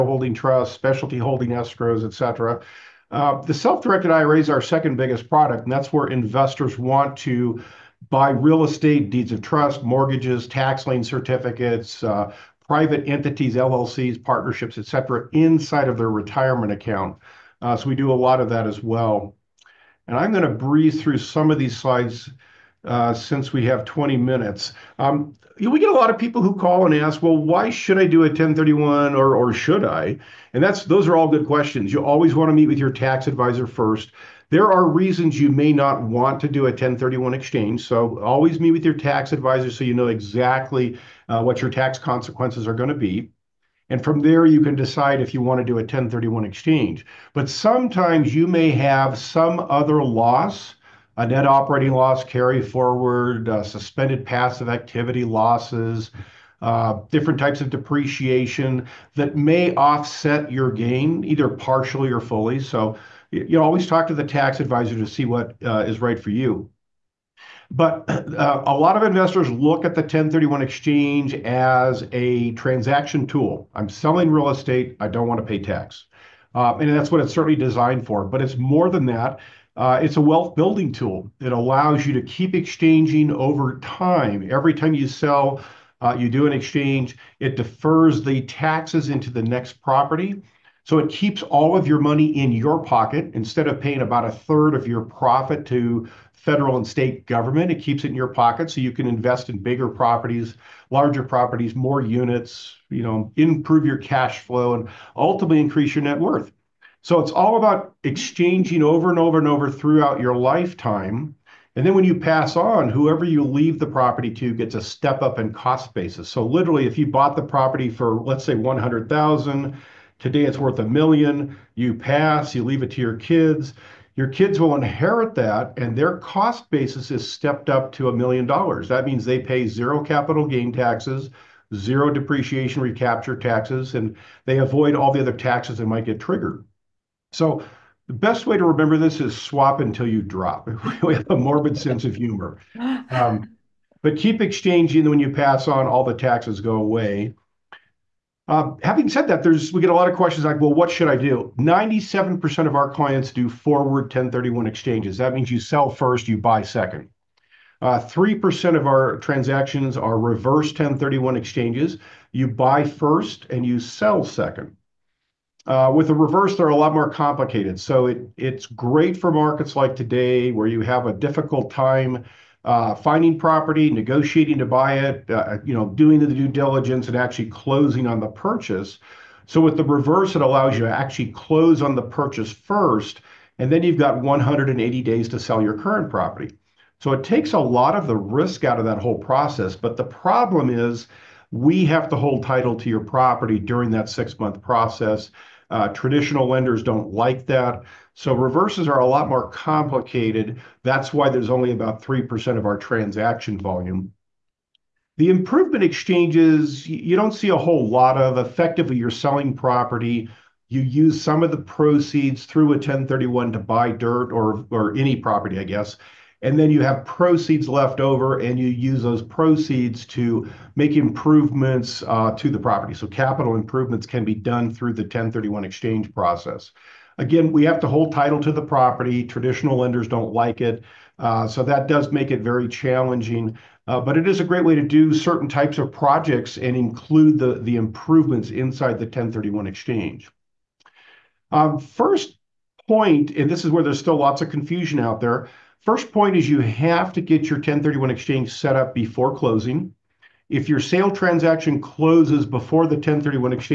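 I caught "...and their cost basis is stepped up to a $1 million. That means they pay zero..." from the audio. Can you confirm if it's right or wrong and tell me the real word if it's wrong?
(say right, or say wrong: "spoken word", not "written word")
right.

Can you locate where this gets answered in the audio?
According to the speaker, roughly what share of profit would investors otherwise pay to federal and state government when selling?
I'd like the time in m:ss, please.
1:34.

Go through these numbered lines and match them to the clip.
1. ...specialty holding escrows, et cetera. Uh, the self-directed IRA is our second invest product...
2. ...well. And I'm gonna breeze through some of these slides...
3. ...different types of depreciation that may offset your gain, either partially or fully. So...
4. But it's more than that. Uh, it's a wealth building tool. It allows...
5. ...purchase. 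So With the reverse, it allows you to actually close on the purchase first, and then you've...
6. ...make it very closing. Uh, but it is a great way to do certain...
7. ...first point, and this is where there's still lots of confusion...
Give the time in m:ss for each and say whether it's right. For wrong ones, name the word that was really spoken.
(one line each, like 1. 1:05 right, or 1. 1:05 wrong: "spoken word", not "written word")
1. 0:00 wrong: "biggest", not "invest"
2. 0:18 right
3. 0:57 right
4. 1:18 right
5. 2:58 right
6. 3:52 wrong: "challenging", not "closing"
7. 4:01 right.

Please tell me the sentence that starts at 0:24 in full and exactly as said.
Um, we get a lot of people who call and ask, well, why should I do a 1031 or, or should I?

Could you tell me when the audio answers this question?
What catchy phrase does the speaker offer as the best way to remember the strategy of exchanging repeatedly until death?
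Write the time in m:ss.
2:19.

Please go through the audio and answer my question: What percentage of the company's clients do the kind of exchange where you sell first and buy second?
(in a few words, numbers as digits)
97%.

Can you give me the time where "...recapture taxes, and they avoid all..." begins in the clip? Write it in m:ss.
2:12.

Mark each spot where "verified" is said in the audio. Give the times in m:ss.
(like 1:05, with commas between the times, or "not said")
not said.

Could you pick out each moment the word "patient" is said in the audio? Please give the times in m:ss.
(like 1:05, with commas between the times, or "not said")
not said.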